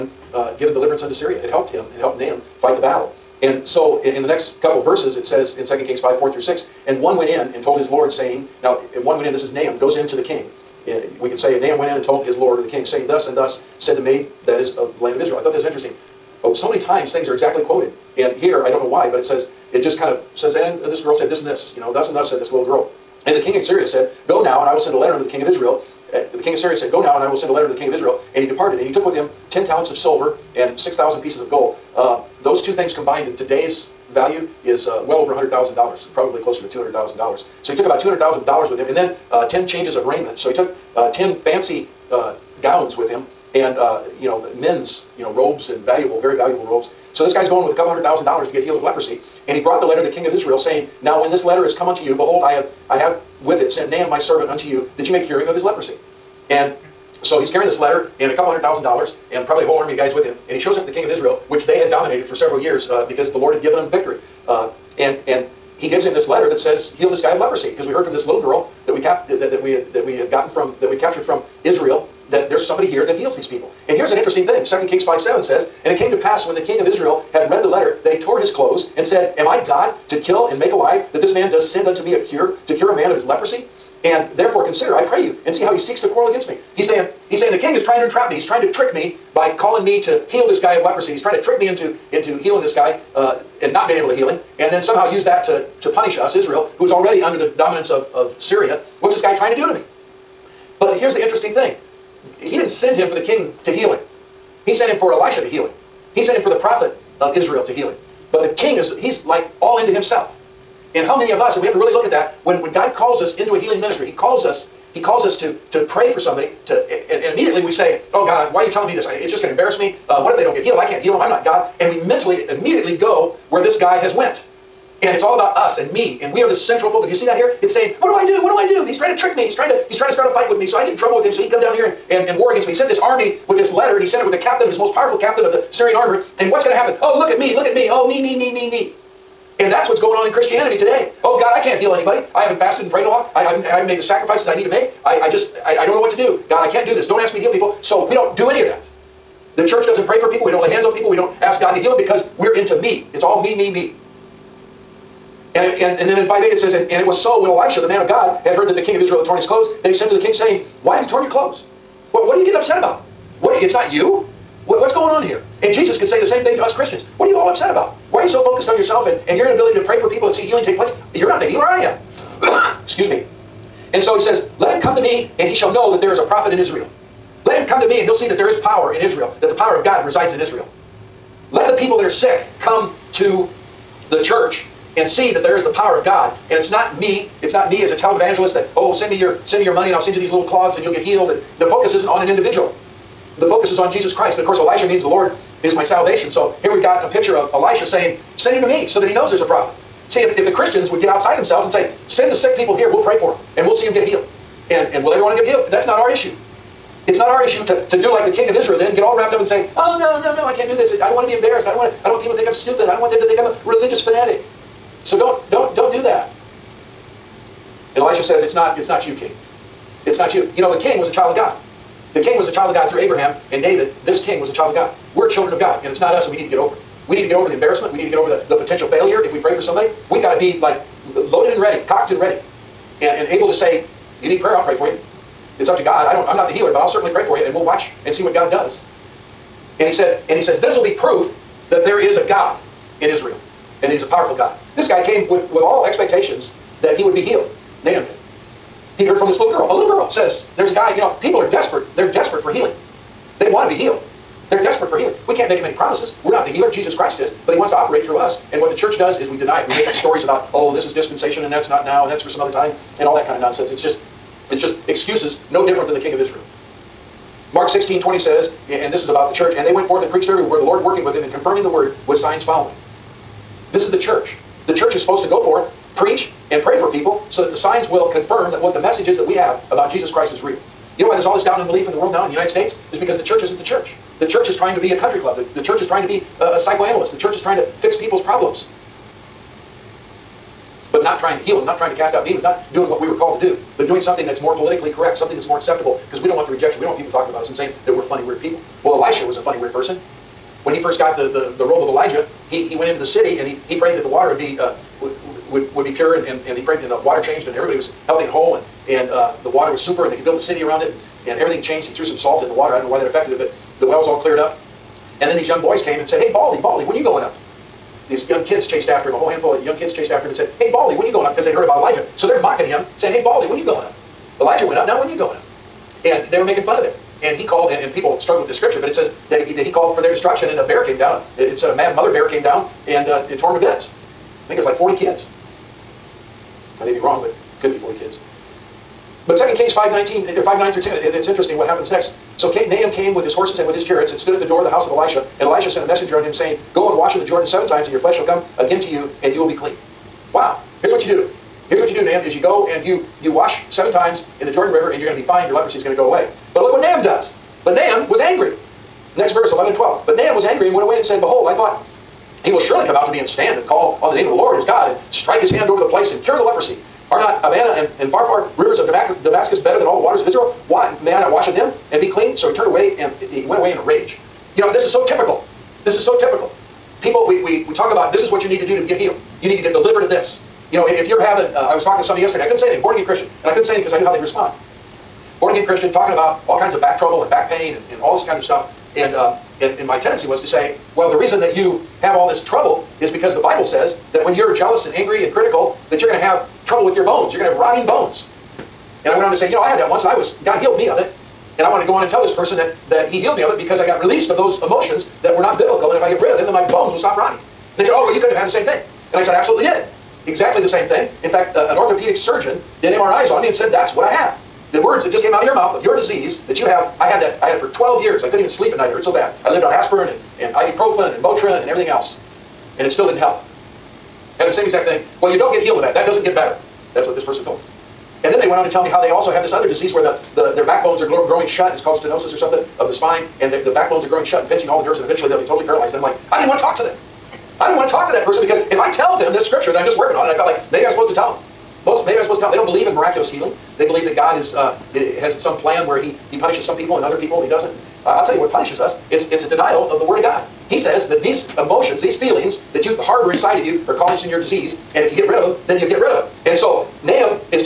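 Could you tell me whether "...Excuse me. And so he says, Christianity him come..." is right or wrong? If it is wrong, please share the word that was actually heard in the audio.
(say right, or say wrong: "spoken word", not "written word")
wrong: "Let", not "Christianity".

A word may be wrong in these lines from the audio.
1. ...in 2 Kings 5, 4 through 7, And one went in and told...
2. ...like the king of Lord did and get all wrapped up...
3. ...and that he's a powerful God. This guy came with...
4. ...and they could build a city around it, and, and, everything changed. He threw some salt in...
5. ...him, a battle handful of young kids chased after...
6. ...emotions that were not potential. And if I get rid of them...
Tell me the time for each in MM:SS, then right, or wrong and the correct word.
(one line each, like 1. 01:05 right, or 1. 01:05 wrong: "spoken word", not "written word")
1. 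00:05 wrong: "6", not "7"
2. 03:28 wrong: "Israel", not "Lord"
3. 04:03 right
4. 05:10 right
5. 05:19 wrong: "whole", not "battle"
6. 06:44 wrong: "biblical", not "potential".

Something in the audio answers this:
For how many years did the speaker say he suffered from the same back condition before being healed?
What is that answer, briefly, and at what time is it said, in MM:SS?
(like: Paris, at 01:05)
12, at 06:57.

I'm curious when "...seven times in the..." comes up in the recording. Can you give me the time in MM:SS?
05:53.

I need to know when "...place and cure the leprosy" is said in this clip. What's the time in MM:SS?
06:05.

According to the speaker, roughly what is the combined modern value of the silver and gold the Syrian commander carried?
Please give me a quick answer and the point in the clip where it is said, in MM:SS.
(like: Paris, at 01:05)
$200,000, at 00:36.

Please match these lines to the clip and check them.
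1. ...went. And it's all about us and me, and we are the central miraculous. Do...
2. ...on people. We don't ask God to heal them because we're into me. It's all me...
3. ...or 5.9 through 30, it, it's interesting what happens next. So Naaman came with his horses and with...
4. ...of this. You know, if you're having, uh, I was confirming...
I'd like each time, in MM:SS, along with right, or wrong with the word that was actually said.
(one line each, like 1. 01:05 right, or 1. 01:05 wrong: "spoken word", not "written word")
1. 02:04 wrong: "focus", not "miraculous"
2. 02:30 right
3. 05:40 wrong: "10", not "30"
4. 06:20 wrong: "talking", not "confirming".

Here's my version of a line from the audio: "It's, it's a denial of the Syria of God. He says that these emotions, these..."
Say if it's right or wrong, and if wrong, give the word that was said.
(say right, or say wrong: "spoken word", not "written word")
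wrong: "Word", not "Syria".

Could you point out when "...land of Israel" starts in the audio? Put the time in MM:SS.
00:15.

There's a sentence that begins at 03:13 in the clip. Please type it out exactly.
The focus is on Jesus Christ.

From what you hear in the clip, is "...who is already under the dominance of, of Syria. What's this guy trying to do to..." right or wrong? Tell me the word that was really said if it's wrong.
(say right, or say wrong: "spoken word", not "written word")
right.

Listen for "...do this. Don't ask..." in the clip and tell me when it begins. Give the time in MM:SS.
02:26.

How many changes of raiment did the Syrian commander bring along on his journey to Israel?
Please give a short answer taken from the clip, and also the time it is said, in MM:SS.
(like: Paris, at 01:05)
10, at 00:39.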